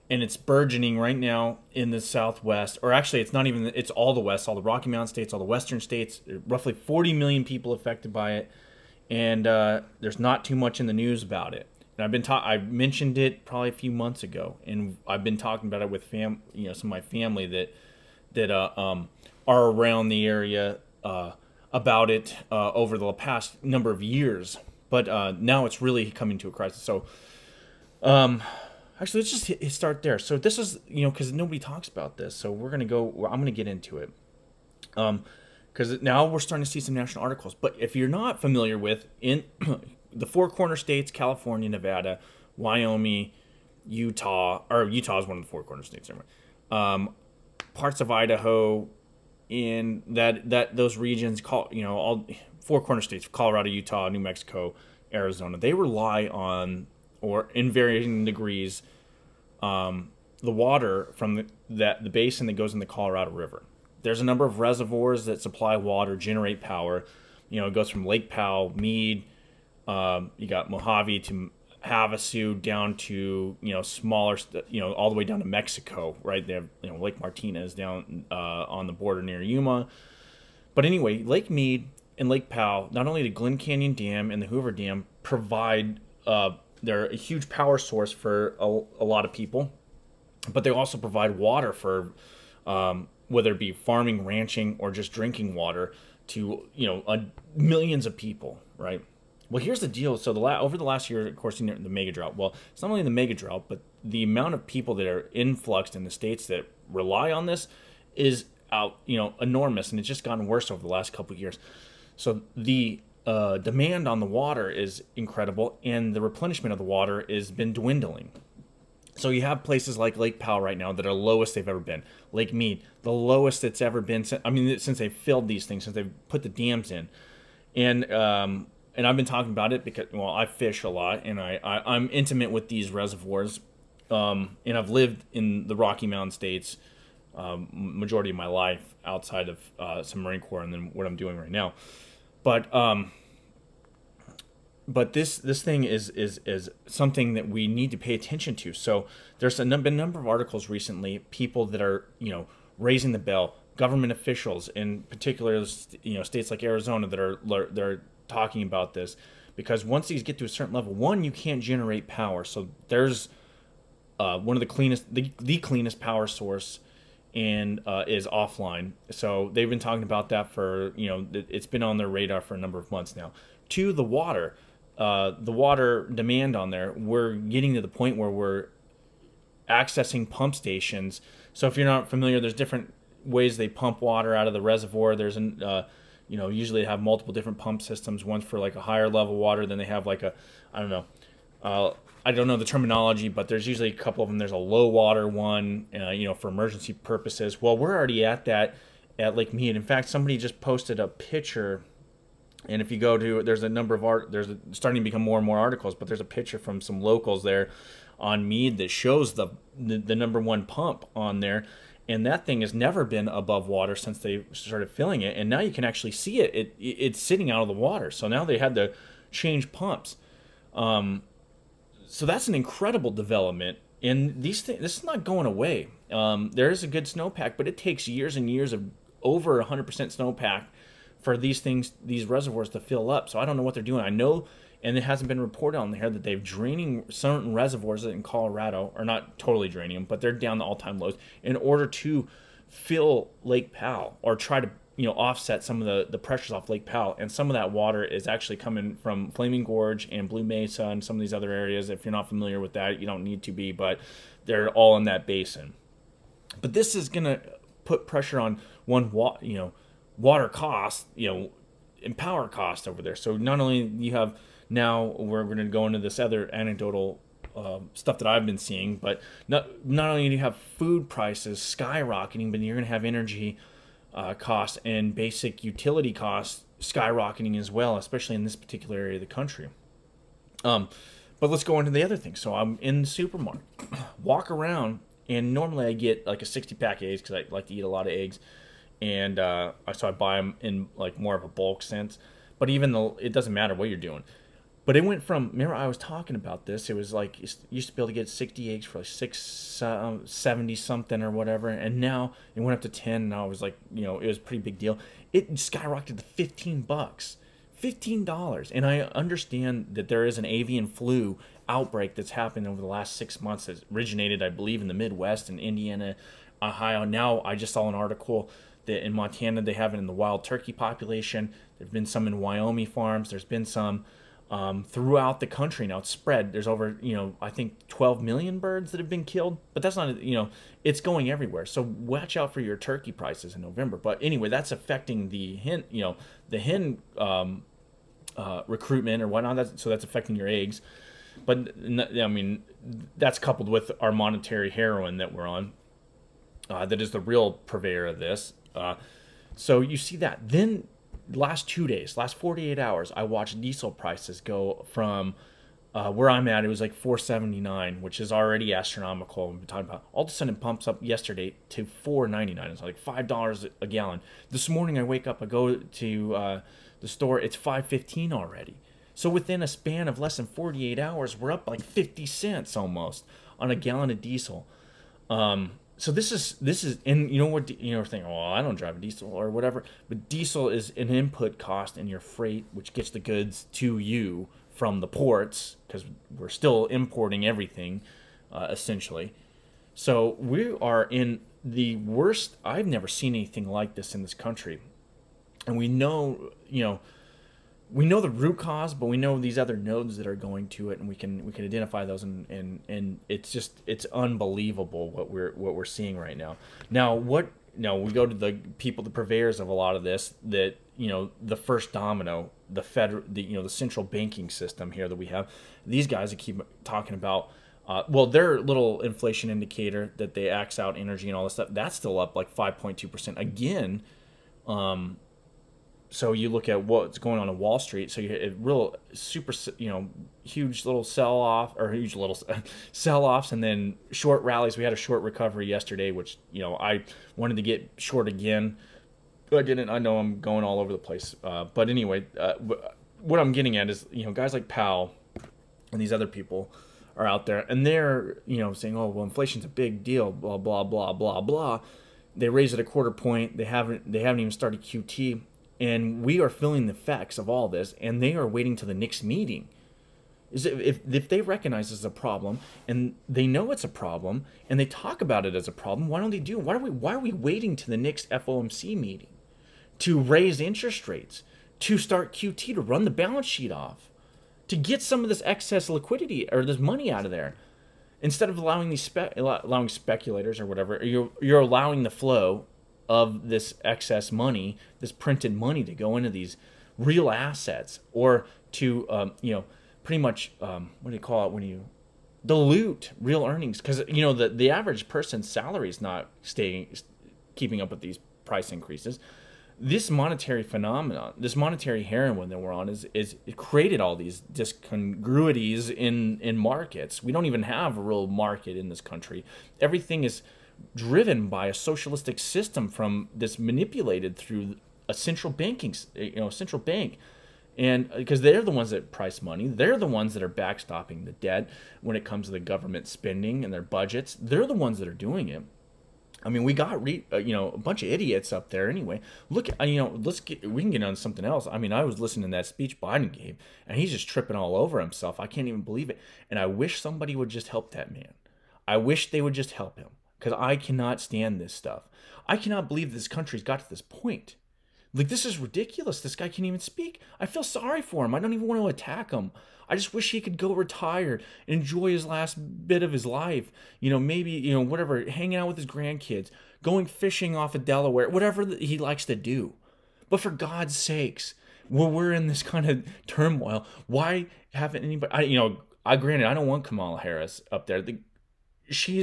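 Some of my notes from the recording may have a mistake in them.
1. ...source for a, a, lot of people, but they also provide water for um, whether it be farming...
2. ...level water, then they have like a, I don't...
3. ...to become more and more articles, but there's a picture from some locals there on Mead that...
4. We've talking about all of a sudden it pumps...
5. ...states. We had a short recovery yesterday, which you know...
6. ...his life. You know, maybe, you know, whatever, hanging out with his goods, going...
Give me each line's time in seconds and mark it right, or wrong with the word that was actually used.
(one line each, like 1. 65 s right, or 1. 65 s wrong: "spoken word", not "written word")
1. 87 s right
2. 189 s right
3. 205 s right
4. 359 s right
5. 434 s wrong: "rallies", not "states"
6. 553 s wrong: "grandkids", not "goods".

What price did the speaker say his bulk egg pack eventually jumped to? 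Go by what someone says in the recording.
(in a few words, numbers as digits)
$15.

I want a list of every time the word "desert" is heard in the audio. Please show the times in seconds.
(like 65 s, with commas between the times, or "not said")
not said.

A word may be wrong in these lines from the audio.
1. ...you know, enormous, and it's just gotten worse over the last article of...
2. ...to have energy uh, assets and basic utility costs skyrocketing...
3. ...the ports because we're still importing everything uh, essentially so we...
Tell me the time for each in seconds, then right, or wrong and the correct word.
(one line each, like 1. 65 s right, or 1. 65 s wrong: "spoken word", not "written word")
1. 109 s wrong: "couple", not "article"
2. 272 s wrong: "costs", not "assets"
3. 385 s right.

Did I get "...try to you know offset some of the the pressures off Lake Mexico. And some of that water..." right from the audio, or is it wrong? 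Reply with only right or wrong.
wrong.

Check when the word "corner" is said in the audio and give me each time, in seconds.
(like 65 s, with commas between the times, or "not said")
40 s, 45 s, 52 s.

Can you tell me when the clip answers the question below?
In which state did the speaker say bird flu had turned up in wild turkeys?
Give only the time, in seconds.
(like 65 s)
319 s.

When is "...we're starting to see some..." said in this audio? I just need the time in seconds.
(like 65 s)
36 s.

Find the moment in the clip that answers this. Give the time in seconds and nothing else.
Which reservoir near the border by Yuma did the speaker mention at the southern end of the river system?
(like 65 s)
76 s.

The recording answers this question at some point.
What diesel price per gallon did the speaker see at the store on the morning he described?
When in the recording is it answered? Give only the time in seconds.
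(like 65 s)
367 s.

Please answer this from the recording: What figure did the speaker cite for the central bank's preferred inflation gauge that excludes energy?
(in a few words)
5.2 percent.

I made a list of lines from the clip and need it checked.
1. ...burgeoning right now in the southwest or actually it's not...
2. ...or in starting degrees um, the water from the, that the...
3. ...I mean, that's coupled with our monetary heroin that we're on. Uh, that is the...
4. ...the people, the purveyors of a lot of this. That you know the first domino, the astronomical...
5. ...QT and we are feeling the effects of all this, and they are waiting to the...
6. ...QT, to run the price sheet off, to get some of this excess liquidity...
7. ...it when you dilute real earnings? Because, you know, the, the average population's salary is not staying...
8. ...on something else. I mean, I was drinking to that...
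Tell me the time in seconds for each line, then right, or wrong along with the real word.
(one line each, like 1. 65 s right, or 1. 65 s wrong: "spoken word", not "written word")
1. 0 s right
2. 57 s wrong: "varying", not "starting"
3. 341 s right
4. 408 s wrong: "federal", not "astronomical"
5. 454 s right
6. 472 s wrong: "balance", not "price"
7. 491 s wrong: "person", not "population"
8. 531 s wrong: "listening", not "drinking".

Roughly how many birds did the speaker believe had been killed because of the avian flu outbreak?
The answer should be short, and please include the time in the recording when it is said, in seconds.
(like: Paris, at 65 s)
12 million, at 327 s.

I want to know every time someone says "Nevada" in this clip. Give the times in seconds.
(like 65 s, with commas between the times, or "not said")
41 s.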